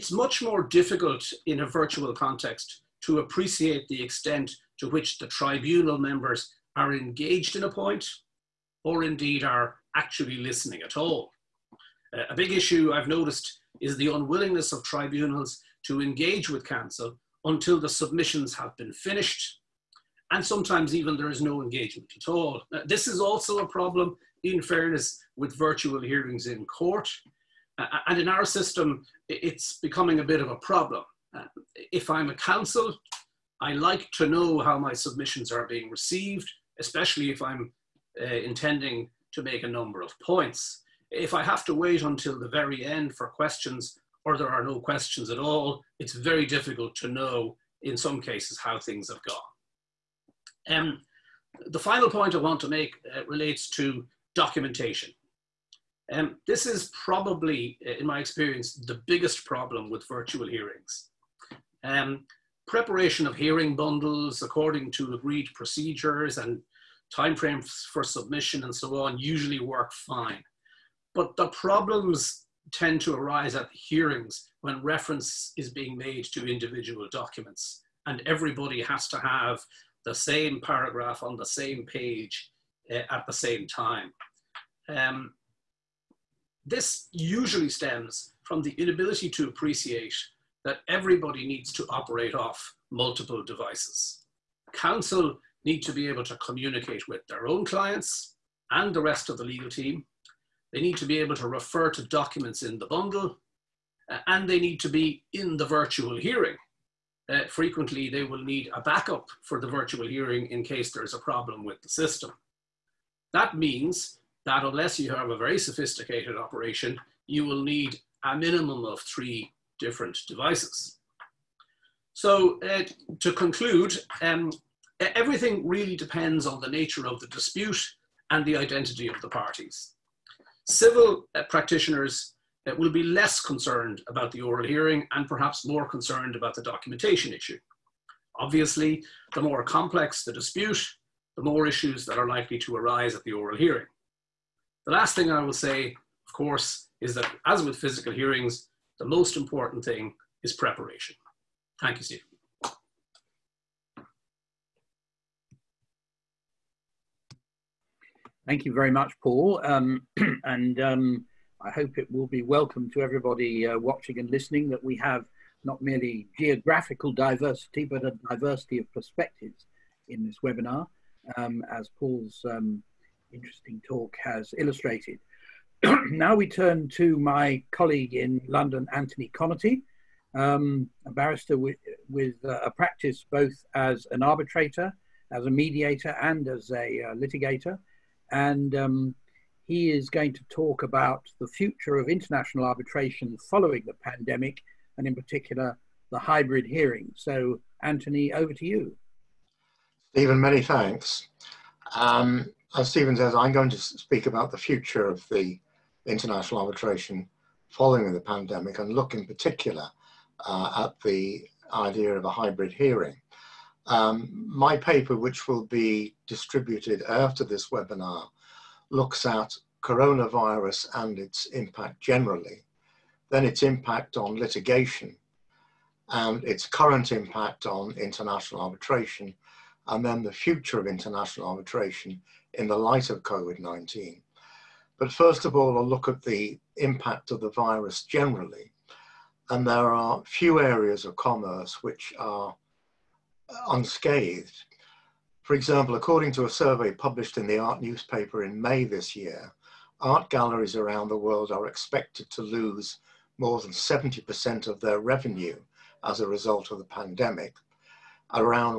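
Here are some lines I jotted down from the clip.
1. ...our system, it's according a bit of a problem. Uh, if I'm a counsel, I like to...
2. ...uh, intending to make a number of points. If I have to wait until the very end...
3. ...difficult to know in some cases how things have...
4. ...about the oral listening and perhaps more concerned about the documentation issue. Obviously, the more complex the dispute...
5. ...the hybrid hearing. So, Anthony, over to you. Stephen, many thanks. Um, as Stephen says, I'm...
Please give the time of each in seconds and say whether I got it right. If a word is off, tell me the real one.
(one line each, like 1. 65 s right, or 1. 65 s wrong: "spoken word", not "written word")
1. 28 s wrong: "becoming", not "according"
2. 38 s right
3. 46 s right
4. 134 s wrong: "hearing", not "listening"
5. 196 s right.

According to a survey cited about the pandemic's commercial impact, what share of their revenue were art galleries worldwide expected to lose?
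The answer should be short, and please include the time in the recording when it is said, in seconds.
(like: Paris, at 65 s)
more than 70%, at 253 s.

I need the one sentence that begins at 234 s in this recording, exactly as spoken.
But first of all, a look at the impact of the virus generally.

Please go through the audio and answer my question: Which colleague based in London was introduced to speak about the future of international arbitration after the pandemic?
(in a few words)
Anthony Connerty.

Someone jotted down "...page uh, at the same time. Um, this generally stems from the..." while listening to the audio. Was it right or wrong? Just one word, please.
wrong.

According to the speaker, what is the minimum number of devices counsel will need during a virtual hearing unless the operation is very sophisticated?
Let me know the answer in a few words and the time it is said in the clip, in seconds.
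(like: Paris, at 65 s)
3, at 119 s.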